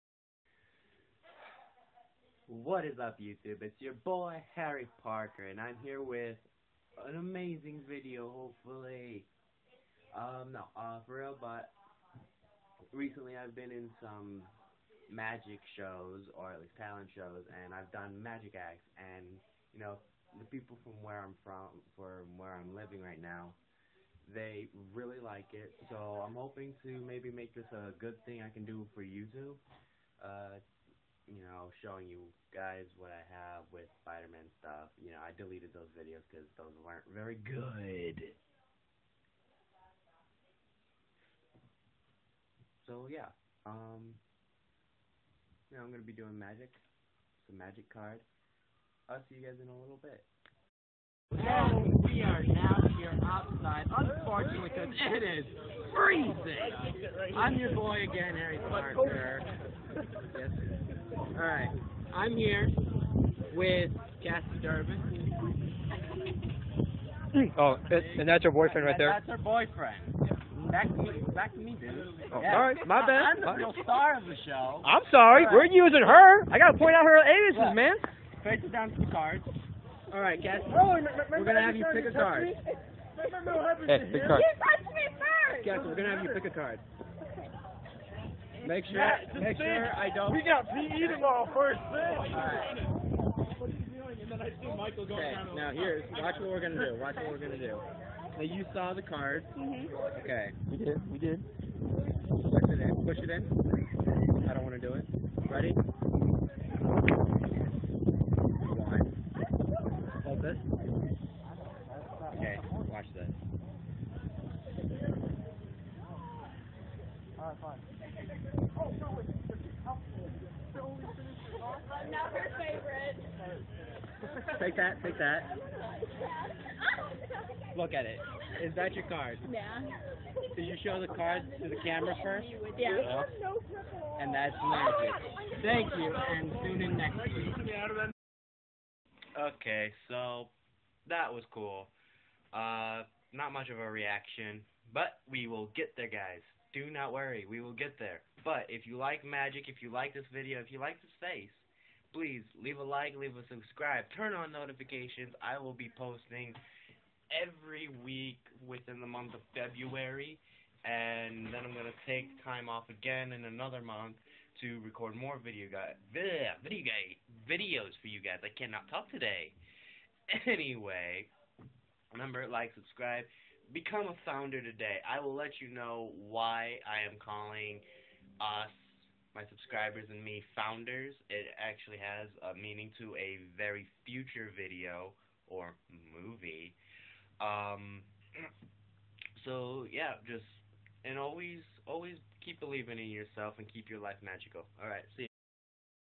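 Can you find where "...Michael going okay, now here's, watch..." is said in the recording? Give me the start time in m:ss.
1:34.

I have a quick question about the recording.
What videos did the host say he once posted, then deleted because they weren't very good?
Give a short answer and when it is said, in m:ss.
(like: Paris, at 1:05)
Spider-Man stuff, at 0:34.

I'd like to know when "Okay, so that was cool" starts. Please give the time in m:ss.
2:19.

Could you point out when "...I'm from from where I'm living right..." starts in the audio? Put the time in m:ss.
0:21.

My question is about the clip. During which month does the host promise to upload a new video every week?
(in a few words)
February.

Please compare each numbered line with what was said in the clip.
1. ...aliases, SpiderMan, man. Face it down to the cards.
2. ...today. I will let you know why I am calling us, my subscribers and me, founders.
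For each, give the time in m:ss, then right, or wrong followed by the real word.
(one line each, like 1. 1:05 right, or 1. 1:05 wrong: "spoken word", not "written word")
1. 1:17 wrong: "Look", not "SpiderMan"
2. 2:54 right.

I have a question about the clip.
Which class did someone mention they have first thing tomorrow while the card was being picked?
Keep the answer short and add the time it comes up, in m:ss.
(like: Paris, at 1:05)
PE, at 1:30.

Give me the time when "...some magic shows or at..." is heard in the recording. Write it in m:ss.
0:14.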